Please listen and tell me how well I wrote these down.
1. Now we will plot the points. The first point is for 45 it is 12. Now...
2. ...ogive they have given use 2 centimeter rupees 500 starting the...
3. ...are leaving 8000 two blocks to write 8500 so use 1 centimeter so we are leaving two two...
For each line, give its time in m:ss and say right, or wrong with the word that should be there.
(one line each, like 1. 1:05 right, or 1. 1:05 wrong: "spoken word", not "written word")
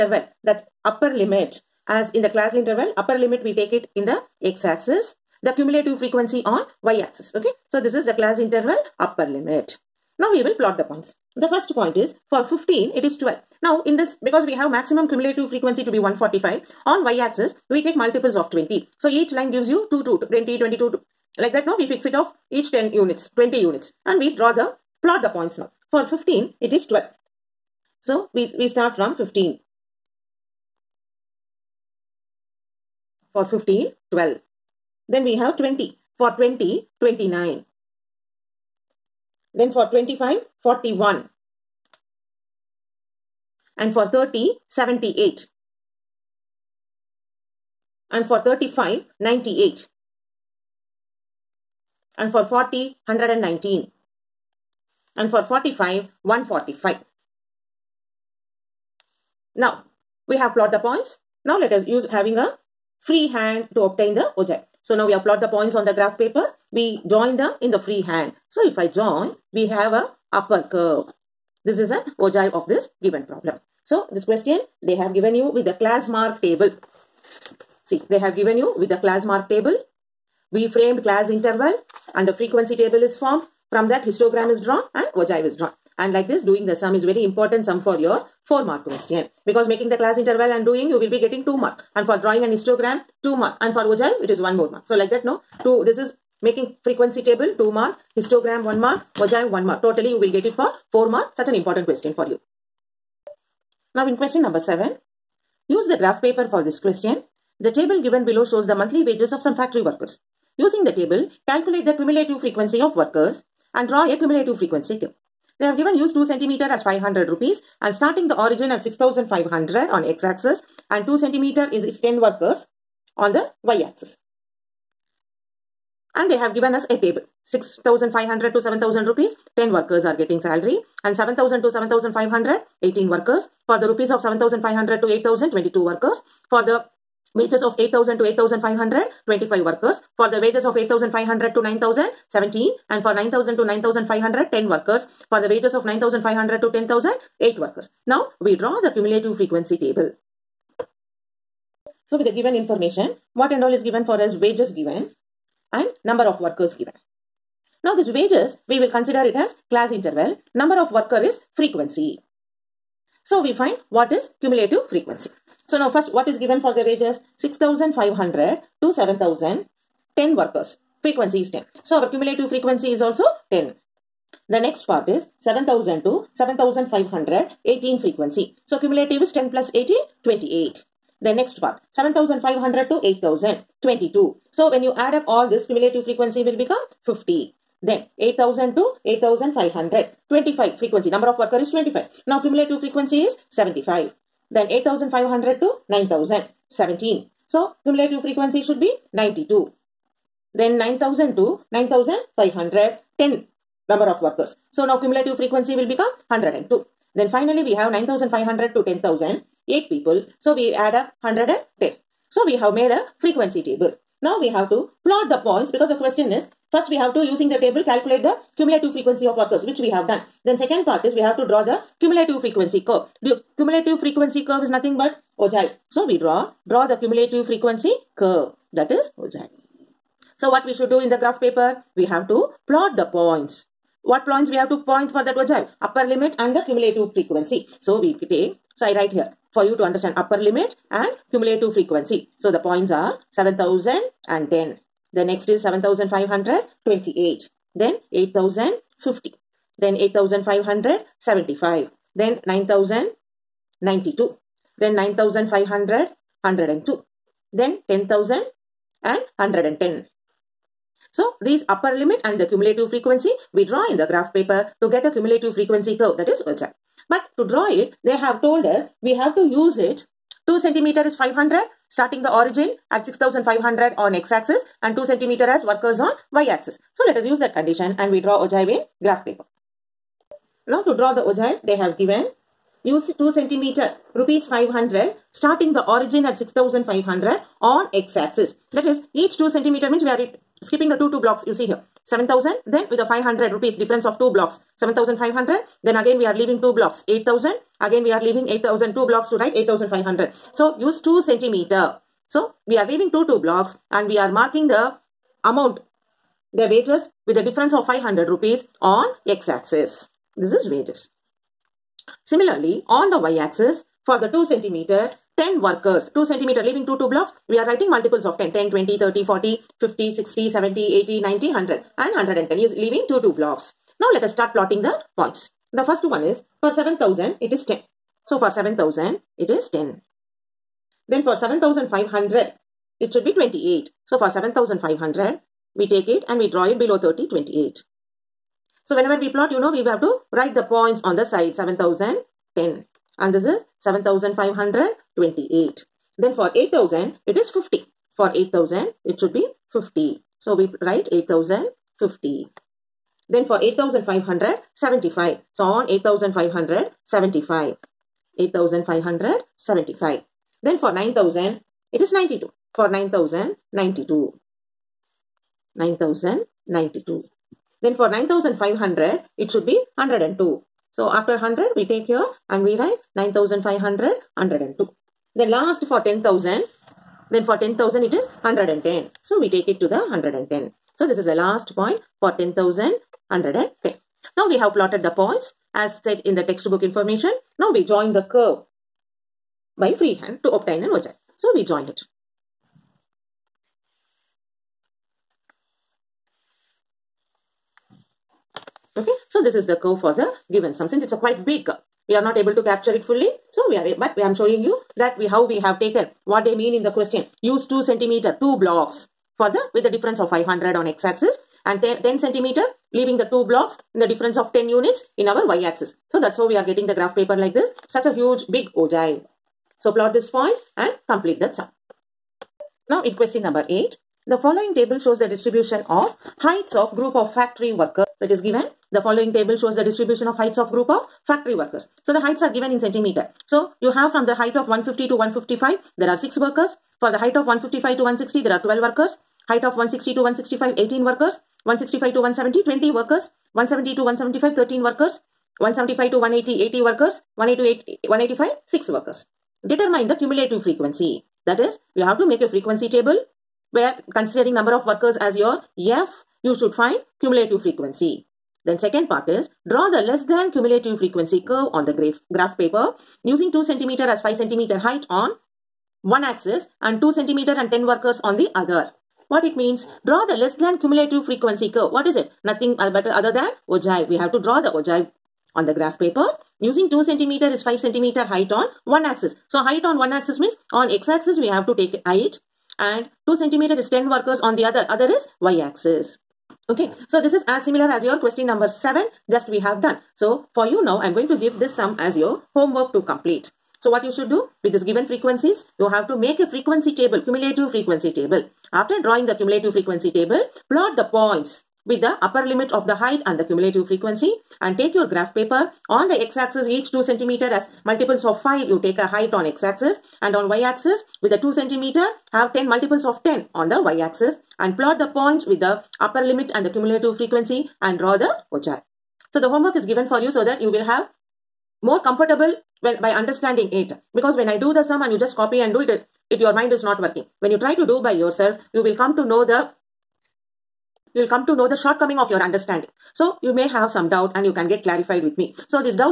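1. 0:10 wrong: "15", not "45"
2. 4:41 right
3. 4:58 wrong: "2", not "1".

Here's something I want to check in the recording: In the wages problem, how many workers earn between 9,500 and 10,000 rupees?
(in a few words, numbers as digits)
8.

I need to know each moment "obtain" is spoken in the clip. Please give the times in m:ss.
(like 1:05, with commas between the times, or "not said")
1:03, 6:30.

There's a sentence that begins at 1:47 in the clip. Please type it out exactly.
The table given below shows the monthly wages of some factory workers.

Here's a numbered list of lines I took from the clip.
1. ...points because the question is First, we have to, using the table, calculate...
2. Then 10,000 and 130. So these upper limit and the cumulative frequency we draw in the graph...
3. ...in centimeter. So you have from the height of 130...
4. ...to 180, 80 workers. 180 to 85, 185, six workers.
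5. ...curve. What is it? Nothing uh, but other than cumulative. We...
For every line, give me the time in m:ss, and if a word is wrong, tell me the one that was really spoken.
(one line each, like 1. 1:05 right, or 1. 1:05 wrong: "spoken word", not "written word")
1. 3:35 right
2. 4:17 wrong: "110", not "130"
3. 7:12 wrong: "150", not "130"
4. 7:26 wrong: "80", not "85"
5. 7:51 wrong: "ogive", not "cumulative".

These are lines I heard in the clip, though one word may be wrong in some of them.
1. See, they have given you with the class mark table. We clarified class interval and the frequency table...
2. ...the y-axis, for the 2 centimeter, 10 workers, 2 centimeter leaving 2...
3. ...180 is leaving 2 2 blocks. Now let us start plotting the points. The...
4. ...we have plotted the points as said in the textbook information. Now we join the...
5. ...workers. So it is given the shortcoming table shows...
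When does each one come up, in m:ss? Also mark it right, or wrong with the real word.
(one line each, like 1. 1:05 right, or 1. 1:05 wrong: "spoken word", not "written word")
1. 1:17 wrong: "framed", not "clarified"
2. 5:13 right
3. 5:22 wrong: "110", not "180"
4. 6:24 right
5. 7:07 wrong: "following", not "shortcoming".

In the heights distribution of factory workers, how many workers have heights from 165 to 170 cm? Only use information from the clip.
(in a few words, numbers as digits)
20.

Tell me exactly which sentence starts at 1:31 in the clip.
And for drawing an histogram 2 mark.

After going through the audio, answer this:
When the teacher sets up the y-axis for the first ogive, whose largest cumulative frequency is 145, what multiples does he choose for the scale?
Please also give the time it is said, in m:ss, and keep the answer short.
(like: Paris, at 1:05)
20, at 0:17.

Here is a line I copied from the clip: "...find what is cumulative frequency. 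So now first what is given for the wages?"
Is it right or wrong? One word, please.
right.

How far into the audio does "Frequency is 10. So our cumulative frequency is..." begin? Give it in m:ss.
2:51.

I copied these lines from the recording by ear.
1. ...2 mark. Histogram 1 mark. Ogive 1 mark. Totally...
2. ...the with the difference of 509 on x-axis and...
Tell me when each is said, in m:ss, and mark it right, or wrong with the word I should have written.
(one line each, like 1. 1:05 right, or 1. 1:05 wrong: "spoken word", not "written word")
1. 1:37 right
2. 6:49 wrong: "500", not "509".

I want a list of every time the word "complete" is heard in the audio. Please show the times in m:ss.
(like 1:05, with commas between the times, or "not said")
7:01, 8:13.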